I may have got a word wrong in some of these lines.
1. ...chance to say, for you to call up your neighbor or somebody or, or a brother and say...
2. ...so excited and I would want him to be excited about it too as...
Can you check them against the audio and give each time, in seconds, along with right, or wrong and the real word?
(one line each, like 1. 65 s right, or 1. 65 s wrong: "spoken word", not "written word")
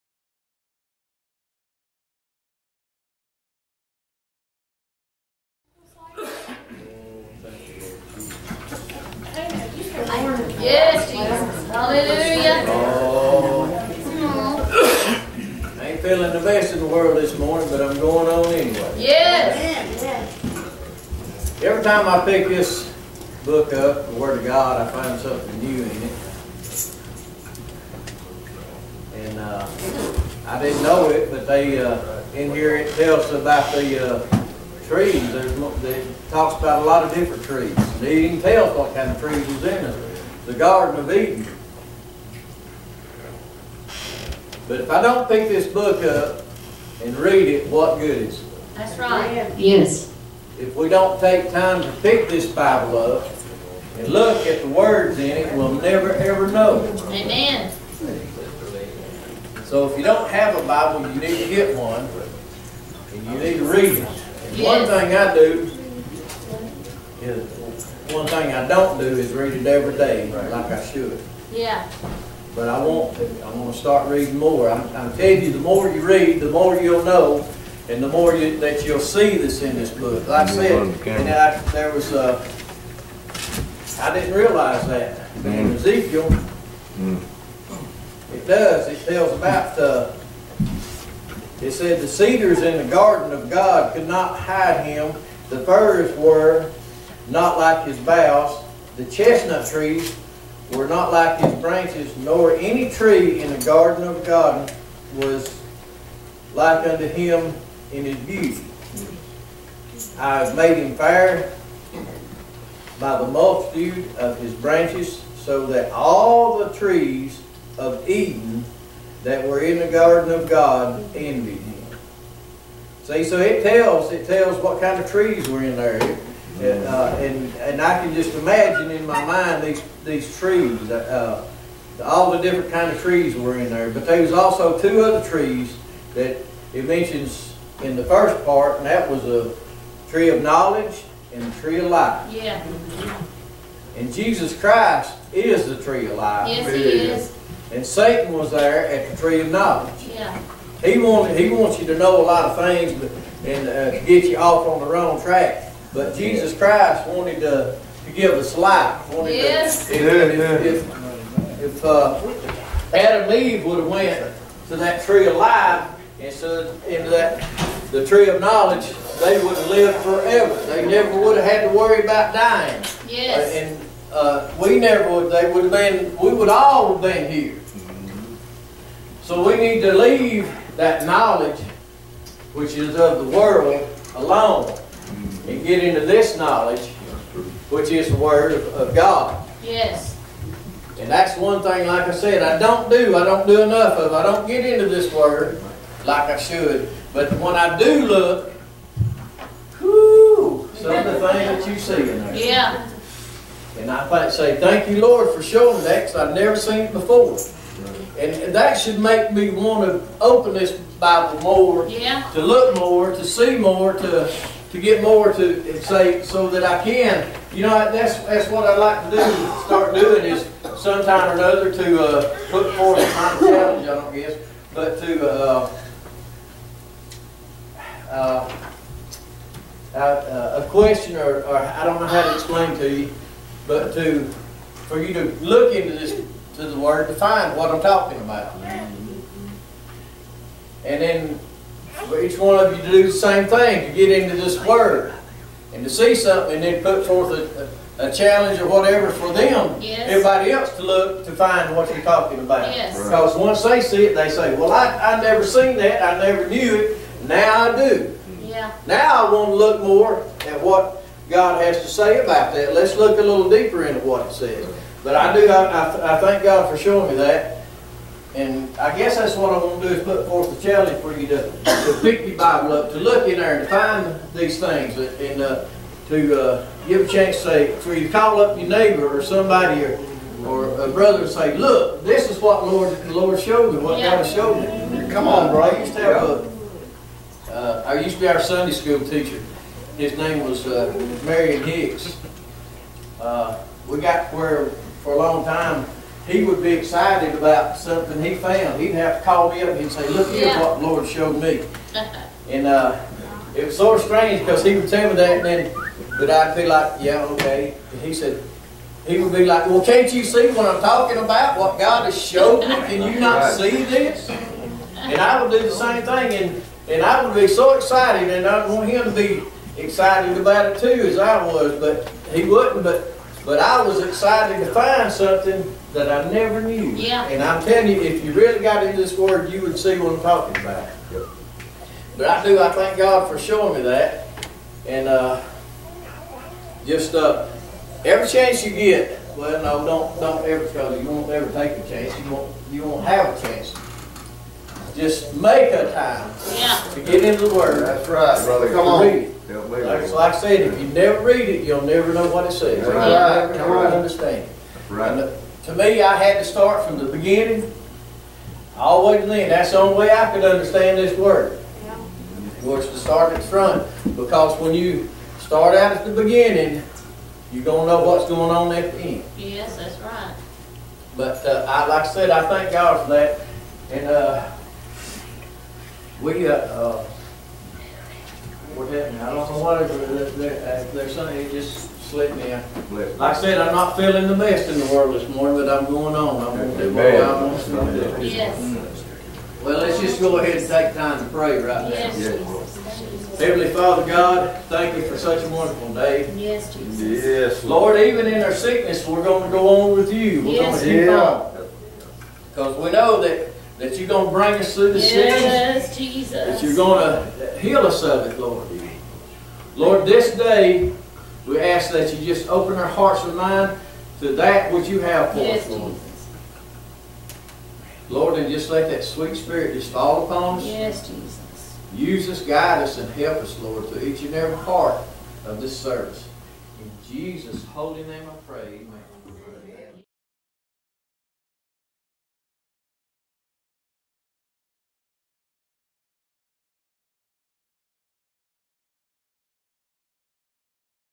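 1. 277 s right
2. 317 s right.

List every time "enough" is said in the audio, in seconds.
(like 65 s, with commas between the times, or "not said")
193 s.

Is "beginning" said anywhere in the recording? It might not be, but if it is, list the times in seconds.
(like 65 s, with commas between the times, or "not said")
357 s, 366 s.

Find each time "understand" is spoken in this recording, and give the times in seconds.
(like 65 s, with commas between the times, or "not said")
353 s, 360 s.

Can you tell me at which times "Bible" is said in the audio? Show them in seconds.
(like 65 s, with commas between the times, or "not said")
52 s, 60 s, 210 s, 272 s.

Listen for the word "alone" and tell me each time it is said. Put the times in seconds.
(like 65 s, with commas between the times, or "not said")
184 s.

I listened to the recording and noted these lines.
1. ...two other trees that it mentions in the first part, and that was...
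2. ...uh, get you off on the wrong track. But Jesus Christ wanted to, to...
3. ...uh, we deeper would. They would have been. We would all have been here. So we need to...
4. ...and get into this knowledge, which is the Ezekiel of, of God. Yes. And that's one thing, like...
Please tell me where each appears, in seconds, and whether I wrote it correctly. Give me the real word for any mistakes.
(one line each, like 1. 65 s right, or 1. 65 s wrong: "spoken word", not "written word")
1. 134 s right
2. 153 s right
3. 174 s wrong: "never", not "deeper"
4. 185 s wrong: "Word", not "Ezekiel".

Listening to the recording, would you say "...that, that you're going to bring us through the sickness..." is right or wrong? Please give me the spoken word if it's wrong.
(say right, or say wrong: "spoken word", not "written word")
right.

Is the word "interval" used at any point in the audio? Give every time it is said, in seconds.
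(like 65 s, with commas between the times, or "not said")
not said.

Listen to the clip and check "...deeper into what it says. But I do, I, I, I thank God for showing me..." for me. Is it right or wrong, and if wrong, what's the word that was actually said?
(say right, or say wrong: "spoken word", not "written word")
right.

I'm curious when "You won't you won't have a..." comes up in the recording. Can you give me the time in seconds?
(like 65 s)
342 s.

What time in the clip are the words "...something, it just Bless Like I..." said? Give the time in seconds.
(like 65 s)
381 s.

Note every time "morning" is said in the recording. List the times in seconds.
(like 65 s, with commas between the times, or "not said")
17 s, 385 s.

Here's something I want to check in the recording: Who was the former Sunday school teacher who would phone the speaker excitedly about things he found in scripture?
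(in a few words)
Marion Hicks.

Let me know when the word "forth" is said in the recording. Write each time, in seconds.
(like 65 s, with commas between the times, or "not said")
222 s, 247 s, 270 s.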